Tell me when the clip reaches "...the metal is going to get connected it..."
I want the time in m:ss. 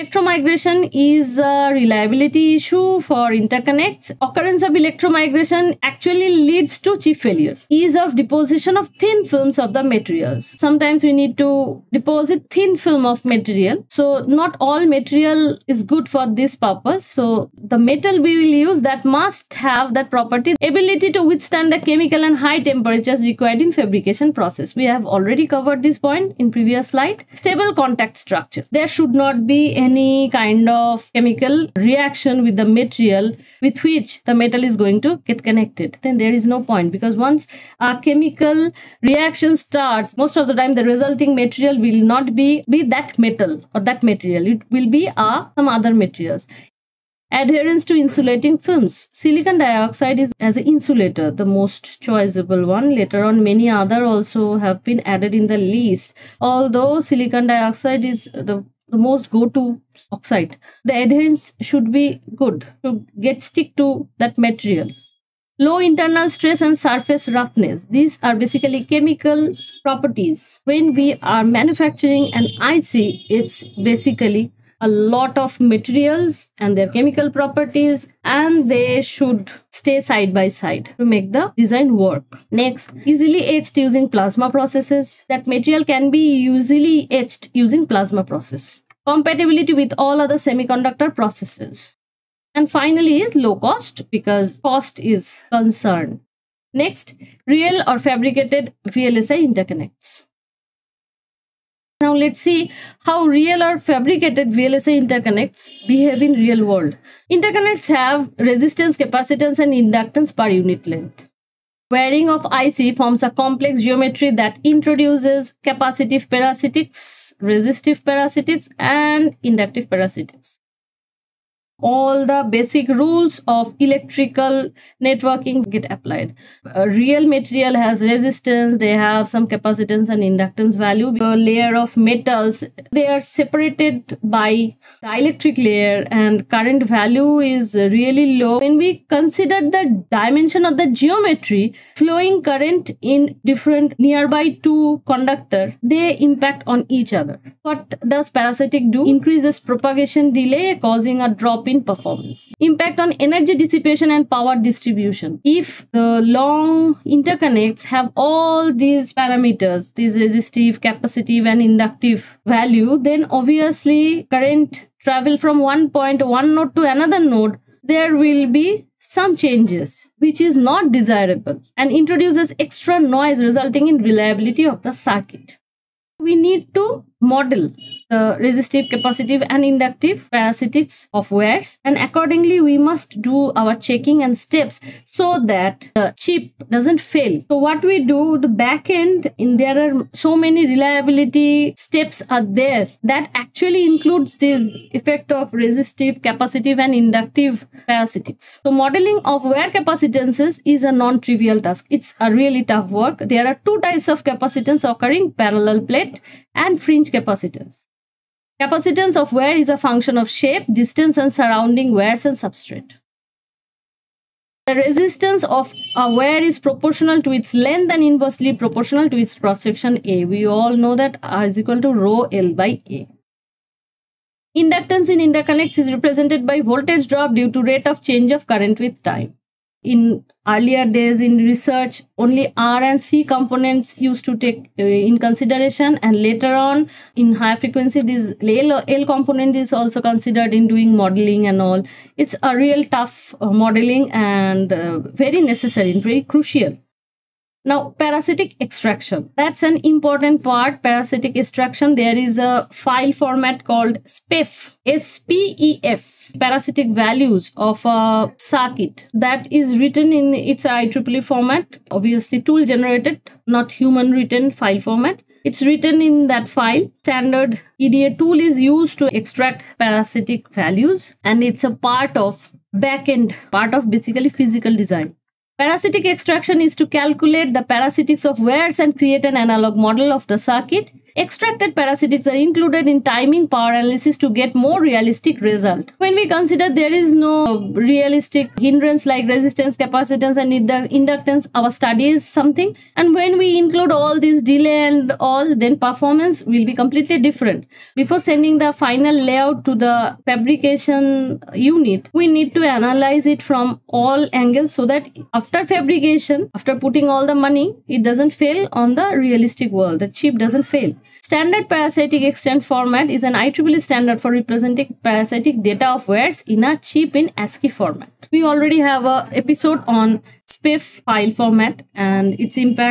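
0:34.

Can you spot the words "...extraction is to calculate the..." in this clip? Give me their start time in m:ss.
4:36.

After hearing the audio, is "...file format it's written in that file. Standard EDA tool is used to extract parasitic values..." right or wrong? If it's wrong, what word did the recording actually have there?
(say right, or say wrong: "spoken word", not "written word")
right.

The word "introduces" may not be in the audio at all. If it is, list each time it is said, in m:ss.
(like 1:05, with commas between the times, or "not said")
1:54, 2:51.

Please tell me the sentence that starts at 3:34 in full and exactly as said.
The resistance of a wear is proportional to its length and inversely proportional to its cross section A.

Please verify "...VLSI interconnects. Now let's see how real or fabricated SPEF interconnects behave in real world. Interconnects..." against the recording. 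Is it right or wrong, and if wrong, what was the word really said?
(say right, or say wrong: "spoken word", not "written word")
wrong: "VLSI", not "SPEF".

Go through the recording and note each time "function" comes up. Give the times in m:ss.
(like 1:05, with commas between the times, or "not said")
3:29.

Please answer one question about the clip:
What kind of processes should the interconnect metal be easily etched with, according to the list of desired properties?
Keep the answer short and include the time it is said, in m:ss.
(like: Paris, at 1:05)
plasma processes, at 1:24.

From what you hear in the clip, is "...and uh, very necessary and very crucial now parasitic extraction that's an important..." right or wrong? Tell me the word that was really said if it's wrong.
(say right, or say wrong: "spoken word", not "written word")
right.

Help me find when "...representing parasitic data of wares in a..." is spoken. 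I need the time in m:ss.
5:14.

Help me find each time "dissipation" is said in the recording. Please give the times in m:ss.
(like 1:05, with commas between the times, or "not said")
2:33.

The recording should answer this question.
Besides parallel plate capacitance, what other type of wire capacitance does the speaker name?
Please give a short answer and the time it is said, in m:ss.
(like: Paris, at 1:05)
fringe capacitance, at 3:26.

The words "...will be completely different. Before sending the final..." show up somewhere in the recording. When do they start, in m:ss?
4:56.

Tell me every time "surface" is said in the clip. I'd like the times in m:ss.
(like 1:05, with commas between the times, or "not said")
1:06.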